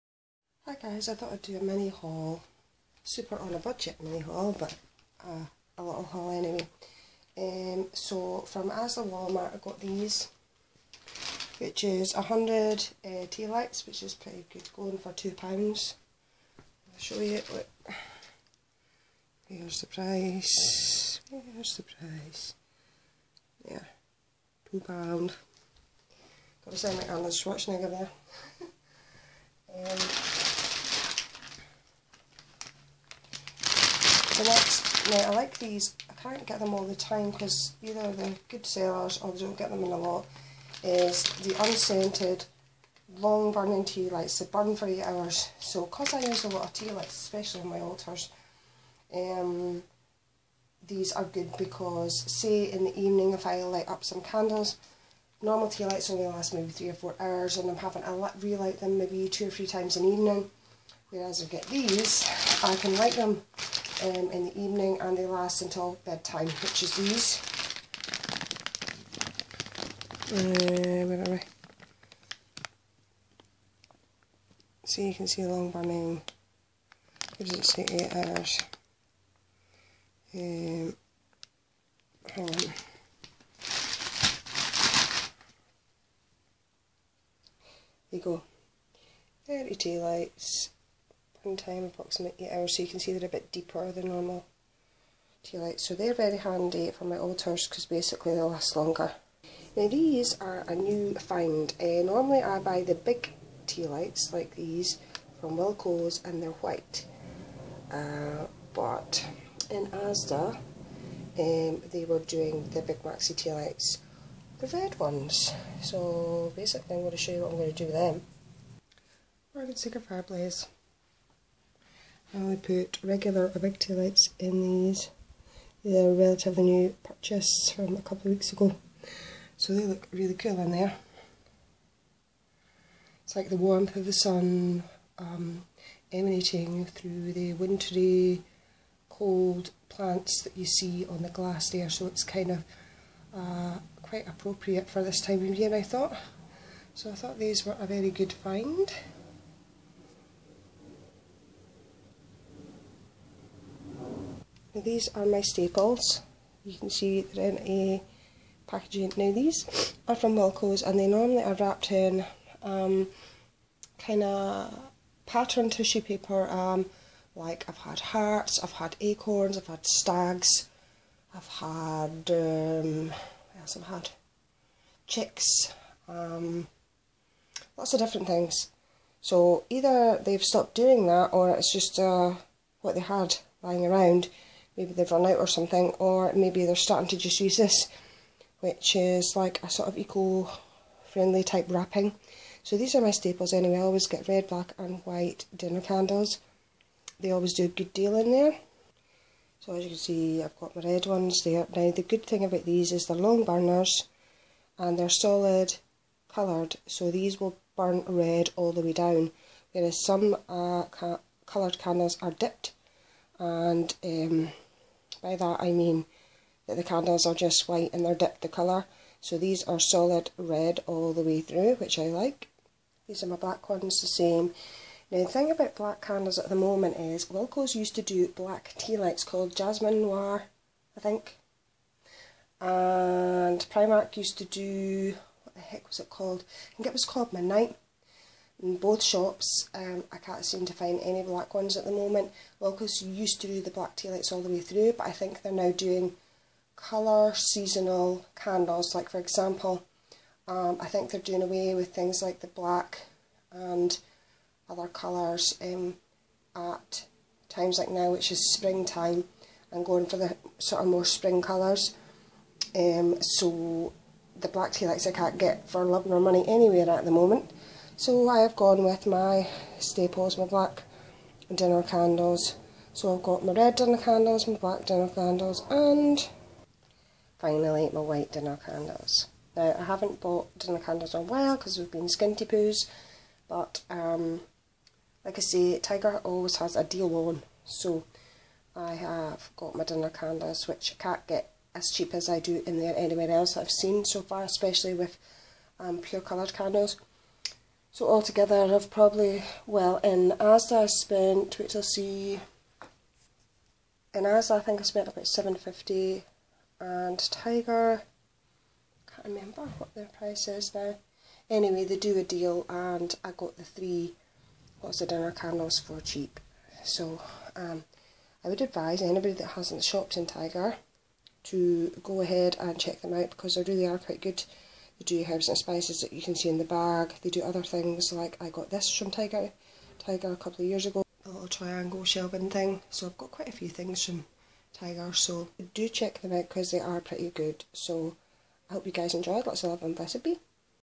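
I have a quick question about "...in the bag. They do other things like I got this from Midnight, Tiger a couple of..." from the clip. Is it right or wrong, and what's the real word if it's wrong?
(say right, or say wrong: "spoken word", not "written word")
wrong: "Tiger", not "Midnight".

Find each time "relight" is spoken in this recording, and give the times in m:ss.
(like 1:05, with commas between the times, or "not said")
0:58.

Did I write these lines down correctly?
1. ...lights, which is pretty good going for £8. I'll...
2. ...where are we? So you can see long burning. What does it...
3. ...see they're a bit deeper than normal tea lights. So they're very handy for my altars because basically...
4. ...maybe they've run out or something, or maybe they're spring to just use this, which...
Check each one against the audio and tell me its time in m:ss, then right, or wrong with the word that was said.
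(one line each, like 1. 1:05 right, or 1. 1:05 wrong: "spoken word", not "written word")
1. 0:13 wrong: "2", not "8"
2. 1:11 right
3. 1:32 right
4. 3:04 wrong: "starting", not "spring".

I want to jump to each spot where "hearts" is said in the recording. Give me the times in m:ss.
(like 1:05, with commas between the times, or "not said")
2:47.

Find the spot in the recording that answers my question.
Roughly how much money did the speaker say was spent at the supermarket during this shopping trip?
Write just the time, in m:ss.
5:05.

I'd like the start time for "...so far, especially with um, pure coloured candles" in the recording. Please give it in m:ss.
4:54.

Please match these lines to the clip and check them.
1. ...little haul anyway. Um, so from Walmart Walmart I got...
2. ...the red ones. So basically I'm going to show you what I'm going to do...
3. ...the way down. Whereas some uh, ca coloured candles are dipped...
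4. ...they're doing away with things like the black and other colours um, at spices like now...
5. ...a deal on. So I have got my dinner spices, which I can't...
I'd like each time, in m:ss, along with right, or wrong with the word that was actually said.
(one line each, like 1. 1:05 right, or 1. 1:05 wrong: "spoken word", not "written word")
1. 0:05 wrong: "Asda", not "Walmart"
2. 1:54 right
3. 3:28 right
4. 4:11 wrong: "times", not "spices"
5. 4:46 wrong: "candles", not "spices".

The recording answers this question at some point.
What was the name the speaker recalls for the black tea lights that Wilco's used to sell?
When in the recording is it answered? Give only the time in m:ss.
3:49.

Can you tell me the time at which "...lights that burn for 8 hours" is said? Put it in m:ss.
0:44.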